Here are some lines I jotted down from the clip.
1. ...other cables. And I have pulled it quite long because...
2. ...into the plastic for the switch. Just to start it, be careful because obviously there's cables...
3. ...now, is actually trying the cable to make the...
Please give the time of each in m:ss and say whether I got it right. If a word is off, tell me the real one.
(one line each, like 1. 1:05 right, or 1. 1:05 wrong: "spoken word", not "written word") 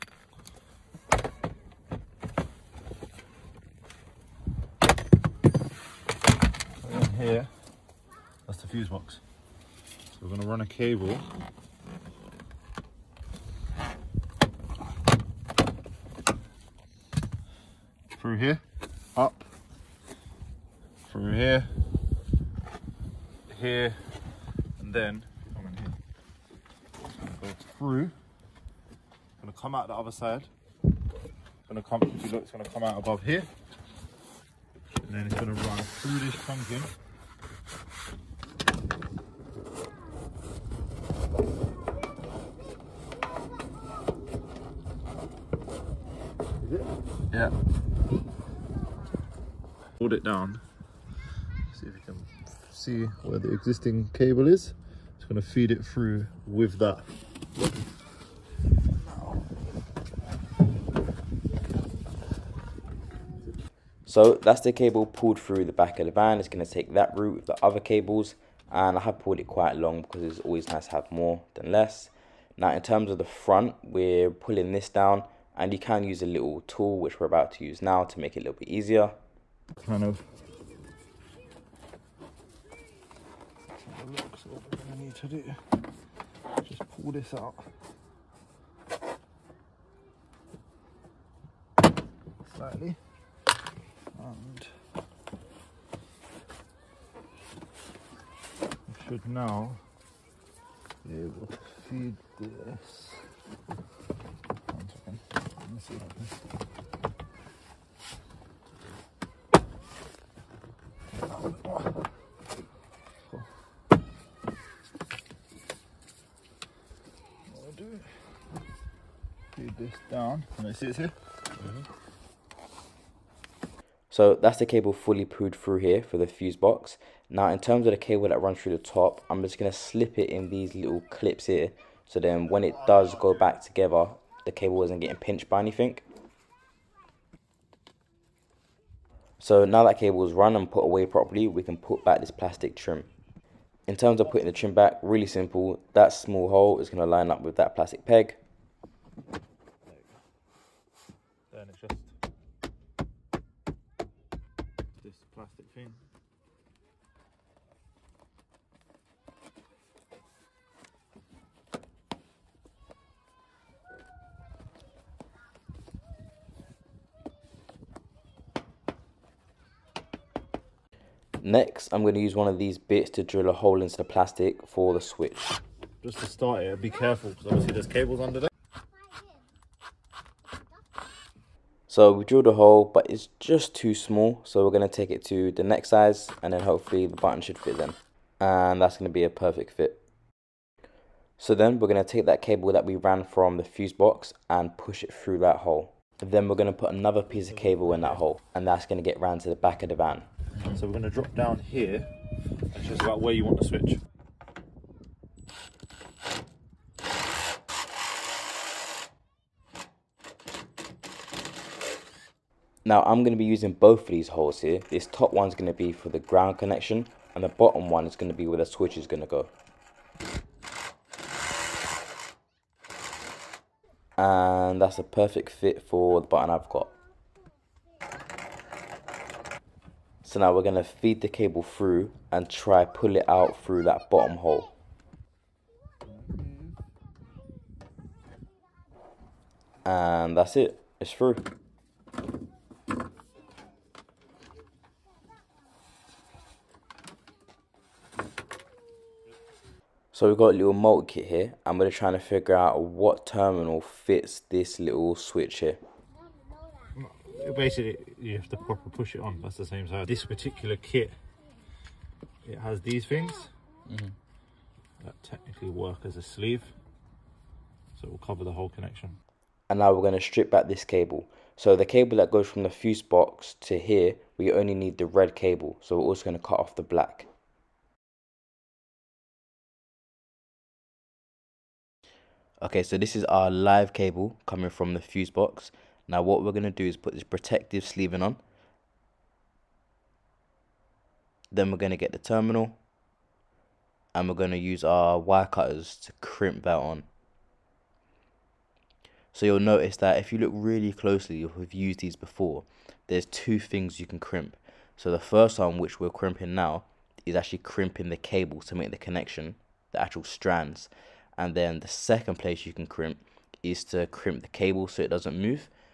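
1. 1:07 right
2. 2:53 right
3. 5:06 wrong: "crimping", not "trying".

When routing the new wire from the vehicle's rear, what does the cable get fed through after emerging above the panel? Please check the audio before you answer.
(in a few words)
Pumpkin.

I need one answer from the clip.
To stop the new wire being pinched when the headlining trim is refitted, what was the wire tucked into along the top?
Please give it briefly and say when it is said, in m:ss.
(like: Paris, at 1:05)
Little clips, at 2:10.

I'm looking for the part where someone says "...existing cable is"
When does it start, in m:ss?
0:53.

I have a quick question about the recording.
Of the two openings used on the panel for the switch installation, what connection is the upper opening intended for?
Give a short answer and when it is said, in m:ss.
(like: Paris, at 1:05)
Ground connection, at 3:36.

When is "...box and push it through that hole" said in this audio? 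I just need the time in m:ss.
3:13.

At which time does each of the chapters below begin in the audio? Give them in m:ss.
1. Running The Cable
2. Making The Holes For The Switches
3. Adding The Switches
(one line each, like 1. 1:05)
1. 0:09
2. 3:23
3. 4:09.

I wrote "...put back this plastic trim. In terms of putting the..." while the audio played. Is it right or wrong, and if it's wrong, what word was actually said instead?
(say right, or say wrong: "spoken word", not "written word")
right.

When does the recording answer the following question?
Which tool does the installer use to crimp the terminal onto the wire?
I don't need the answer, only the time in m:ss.
4:55.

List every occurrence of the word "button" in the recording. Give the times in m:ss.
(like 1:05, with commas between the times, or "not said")
3:07, 3:46.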